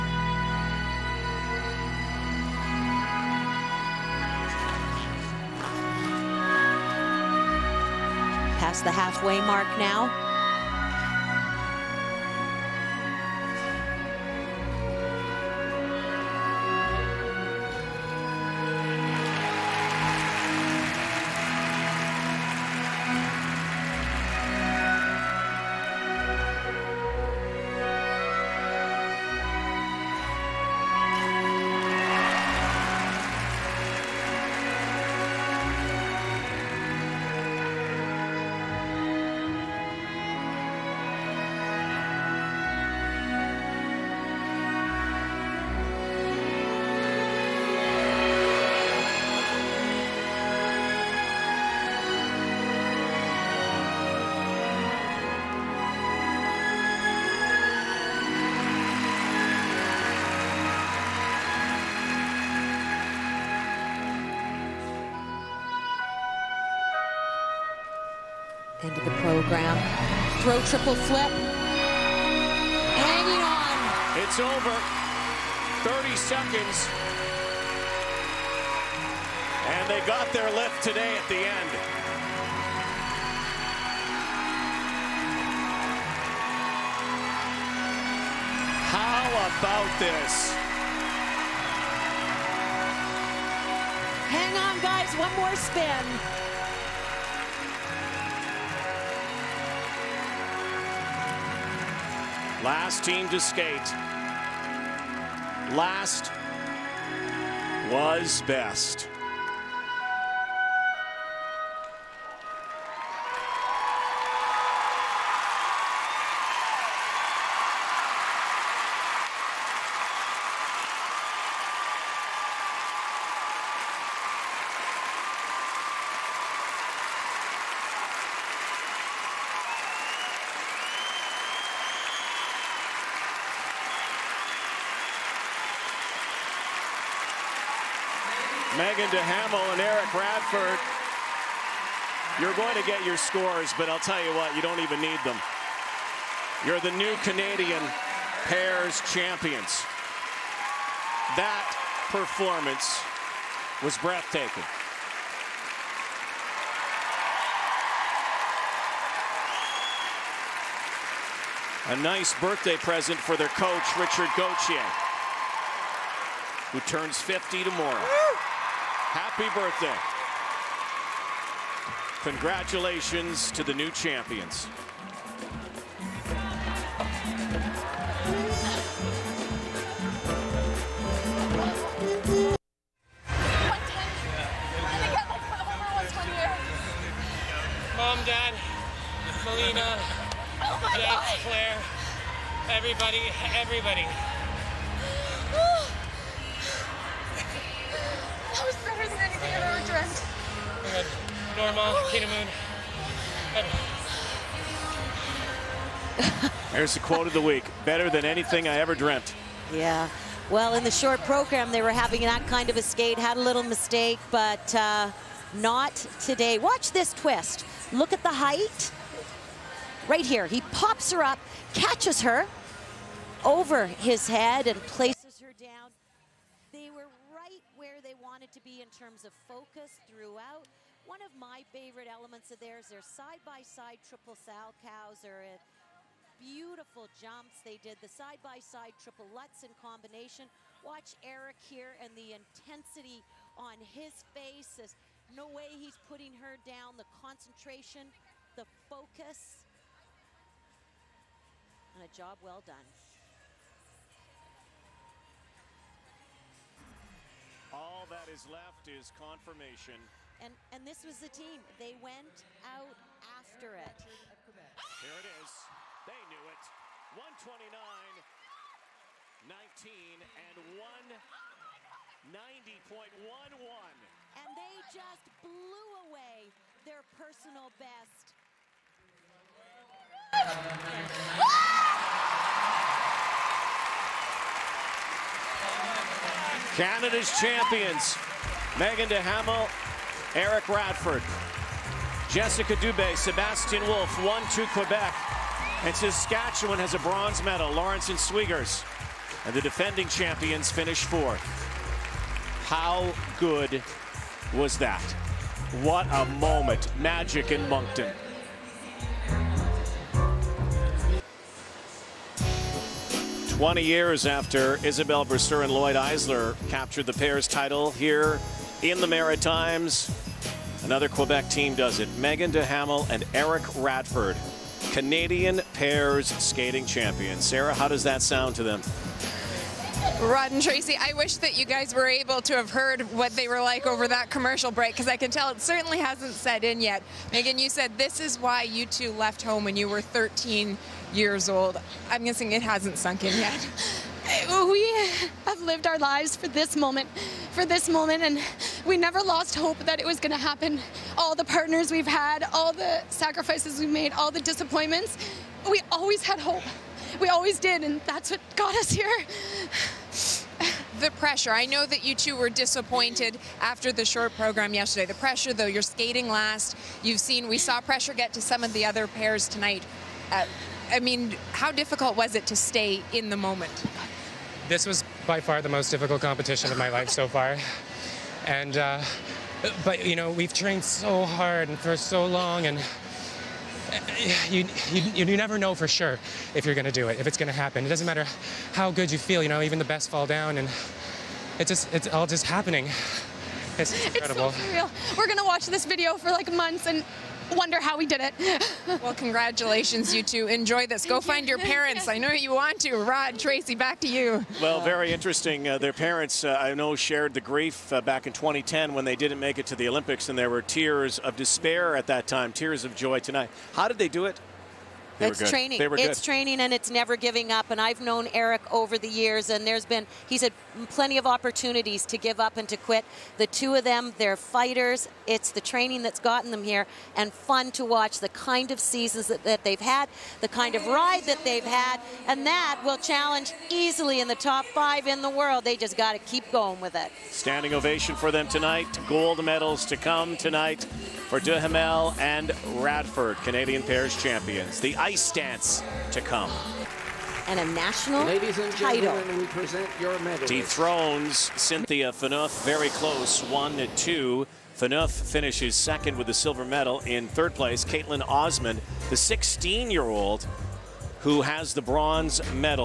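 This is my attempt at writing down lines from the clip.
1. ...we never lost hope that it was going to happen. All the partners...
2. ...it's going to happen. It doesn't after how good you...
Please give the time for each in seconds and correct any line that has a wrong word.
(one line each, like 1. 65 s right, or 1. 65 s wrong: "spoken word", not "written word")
1. 348 s right
2. 387 s wrong: "matter", not "after".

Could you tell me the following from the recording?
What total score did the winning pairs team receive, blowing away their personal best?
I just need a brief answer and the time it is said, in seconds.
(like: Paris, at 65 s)
190.11, at 271 s.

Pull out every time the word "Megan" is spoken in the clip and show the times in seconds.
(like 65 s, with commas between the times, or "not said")
337 s.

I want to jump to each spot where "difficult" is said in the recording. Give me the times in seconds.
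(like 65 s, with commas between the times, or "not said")
371 s, 375 s.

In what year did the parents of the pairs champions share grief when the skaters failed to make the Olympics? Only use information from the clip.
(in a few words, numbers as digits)
2010.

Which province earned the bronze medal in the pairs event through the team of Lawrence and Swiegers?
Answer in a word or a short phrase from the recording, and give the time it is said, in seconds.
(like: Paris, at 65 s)
Saskatchewan, at 295 s.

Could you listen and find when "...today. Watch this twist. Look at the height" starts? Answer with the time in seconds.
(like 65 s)
216 s.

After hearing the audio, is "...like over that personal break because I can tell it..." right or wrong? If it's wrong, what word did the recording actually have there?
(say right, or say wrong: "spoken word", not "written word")
wrong: "commercial", not "personal".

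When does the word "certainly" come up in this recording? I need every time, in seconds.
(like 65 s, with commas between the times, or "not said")
335 s.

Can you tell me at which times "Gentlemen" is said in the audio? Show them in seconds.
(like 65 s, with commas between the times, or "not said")
449 s.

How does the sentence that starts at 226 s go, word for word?
They were right where they wanted to be in terms of focus throughout.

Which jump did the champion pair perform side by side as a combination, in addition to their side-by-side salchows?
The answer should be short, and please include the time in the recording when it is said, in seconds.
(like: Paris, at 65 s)
triple lutz, at 239 s.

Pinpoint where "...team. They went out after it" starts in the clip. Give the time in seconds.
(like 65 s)
261 s.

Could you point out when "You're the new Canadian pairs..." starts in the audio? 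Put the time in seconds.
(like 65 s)
146 s.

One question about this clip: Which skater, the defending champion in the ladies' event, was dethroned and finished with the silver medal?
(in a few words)
Cynthia Phaneuf.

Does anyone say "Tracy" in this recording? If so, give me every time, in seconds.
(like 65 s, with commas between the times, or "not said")
330 s, 403 s.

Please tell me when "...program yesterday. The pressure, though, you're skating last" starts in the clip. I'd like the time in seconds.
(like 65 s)
364 s.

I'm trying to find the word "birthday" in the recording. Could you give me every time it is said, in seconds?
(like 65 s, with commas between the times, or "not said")
162 s, 169 s.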